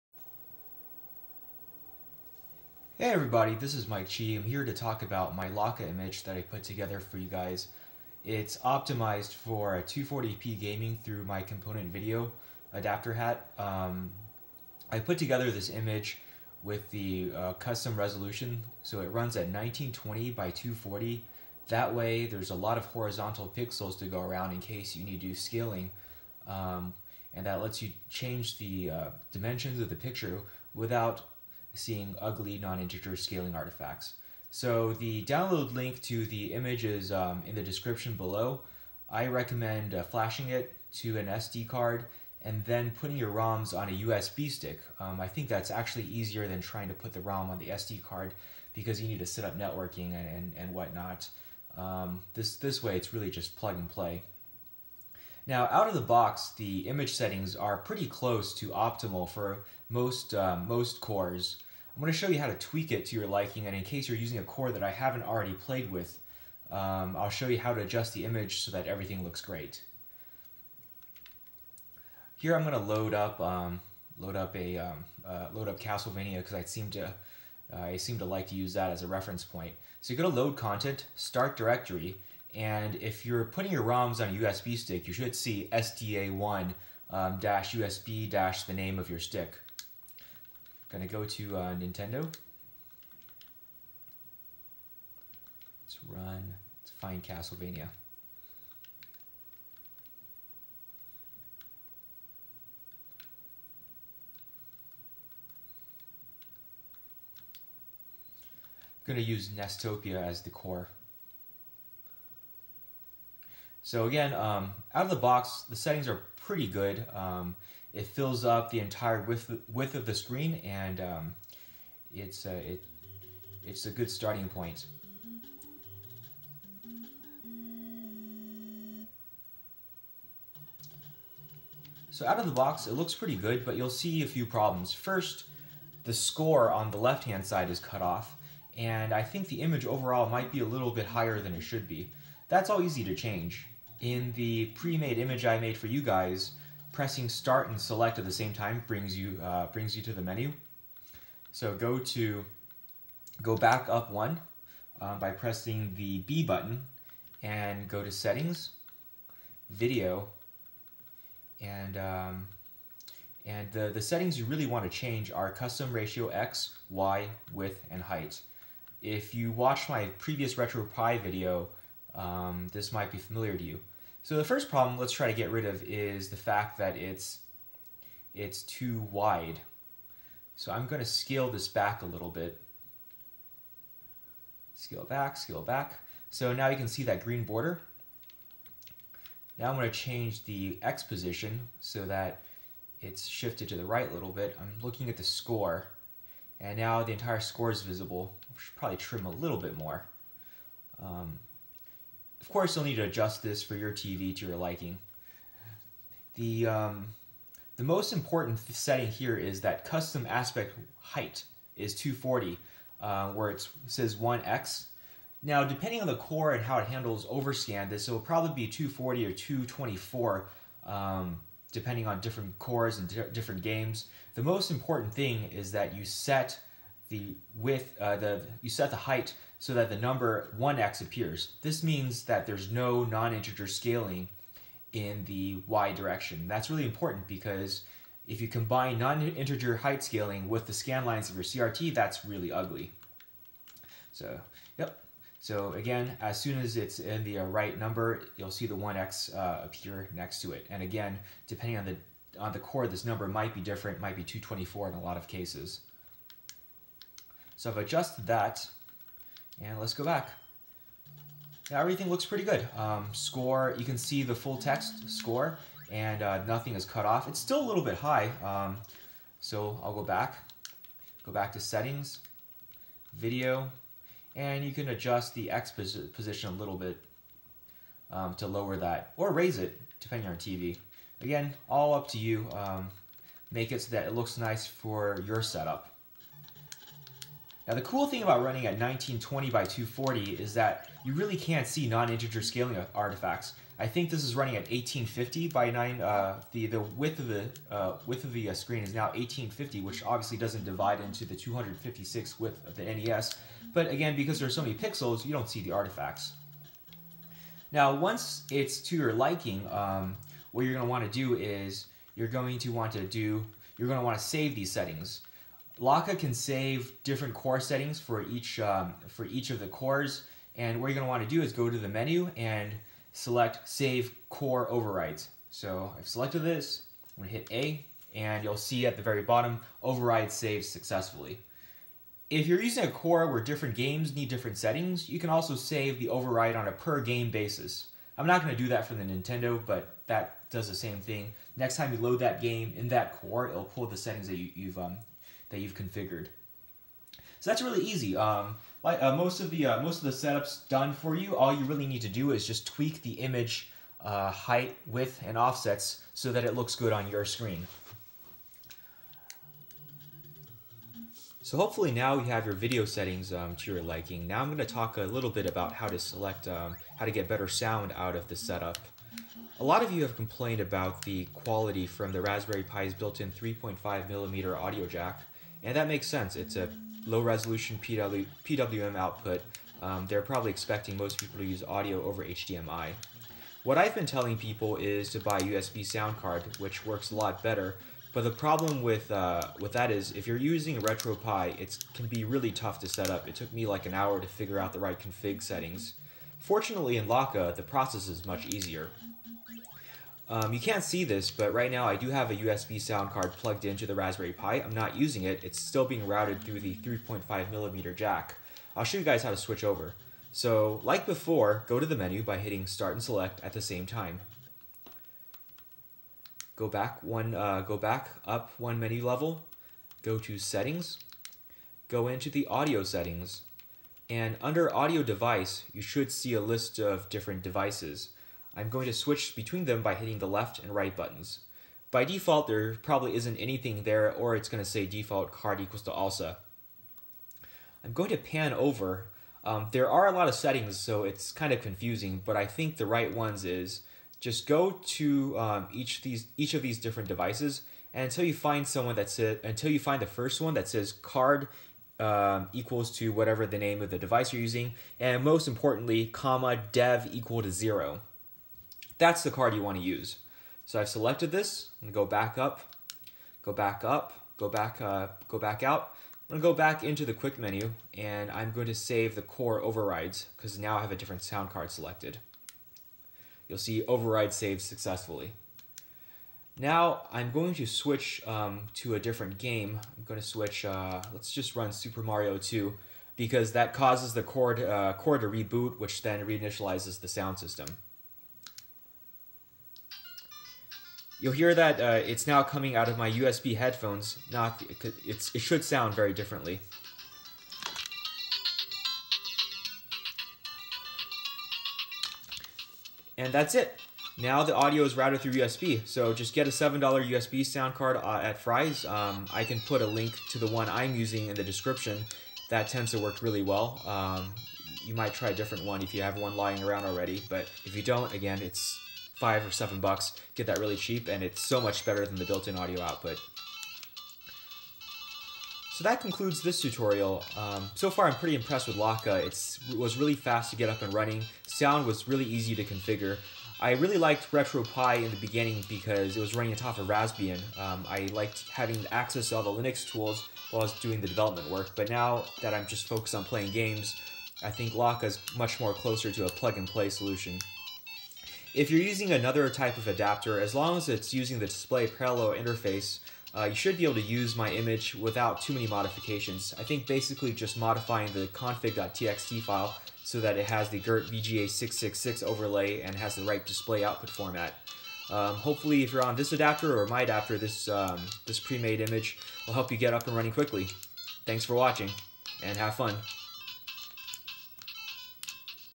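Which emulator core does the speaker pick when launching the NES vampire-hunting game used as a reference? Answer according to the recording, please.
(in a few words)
Nestopia.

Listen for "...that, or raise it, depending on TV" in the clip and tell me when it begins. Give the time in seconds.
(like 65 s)
278 s.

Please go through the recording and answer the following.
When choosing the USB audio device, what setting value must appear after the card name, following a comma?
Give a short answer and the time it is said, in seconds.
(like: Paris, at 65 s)
dev equal to zero, at 456 s.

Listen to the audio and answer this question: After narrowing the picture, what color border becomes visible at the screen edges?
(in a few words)
green.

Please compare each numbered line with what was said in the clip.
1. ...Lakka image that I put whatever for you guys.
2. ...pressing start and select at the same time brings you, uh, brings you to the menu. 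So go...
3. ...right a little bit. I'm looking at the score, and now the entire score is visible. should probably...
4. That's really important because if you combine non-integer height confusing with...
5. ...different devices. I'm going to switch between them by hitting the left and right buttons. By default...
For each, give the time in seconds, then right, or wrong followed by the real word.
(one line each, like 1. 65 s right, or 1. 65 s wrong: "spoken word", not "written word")
1. 5 s wrong: "together", not "whatever"
2. 146 s right
3. 193 s right
4. 236 s wrong: "scaling", not "confusing"
5. 427 s right.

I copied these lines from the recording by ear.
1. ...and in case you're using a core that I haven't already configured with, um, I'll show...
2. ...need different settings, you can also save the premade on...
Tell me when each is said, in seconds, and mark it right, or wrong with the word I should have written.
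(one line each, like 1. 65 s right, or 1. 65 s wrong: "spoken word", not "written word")
1. 63 s wrong: "played", not "configured"
2. 334 s wrong: "override", not "premade".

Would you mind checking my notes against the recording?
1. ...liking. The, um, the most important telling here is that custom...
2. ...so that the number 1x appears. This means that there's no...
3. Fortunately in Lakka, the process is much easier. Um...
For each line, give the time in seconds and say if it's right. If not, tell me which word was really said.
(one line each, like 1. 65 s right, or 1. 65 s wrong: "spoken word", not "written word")
1. 204 s wrong: "setting", not "telling"
2. 229 s right
3. 396 s right.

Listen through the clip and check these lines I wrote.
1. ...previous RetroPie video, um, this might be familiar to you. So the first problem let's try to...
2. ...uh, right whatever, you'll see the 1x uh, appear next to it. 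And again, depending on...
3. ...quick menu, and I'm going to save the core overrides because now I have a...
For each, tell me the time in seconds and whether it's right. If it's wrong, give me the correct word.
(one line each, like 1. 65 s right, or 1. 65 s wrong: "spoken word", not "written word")
1. 170 s right
2. 247 s wrong: "number", not "whatever"
3. 467 s right.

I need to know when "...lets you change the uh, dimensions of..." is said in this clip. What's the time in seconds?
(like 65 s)
27 s.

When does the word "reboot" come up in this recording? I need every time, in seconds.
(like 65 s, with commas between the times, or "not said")
485 s.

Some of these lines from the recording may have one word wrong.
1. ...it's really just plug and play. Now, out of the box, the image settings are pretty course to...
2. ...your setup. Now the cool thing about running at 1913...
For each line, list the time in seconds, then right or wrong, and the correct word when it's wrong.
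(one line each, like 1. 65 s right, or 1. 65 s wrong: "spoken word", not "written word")
1. 52 s wrong: "close", not "course"
2. 285 s wrong: "1920", not "1913".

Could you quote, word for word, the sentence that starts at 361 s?
So hopefully now you have your video settings um, to your liking.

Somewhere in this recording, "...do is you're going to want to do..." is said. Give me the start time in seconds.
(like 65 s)
311 s.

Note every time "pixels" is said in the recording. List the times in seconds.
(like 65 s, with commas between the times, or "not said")
23 s, 304 s.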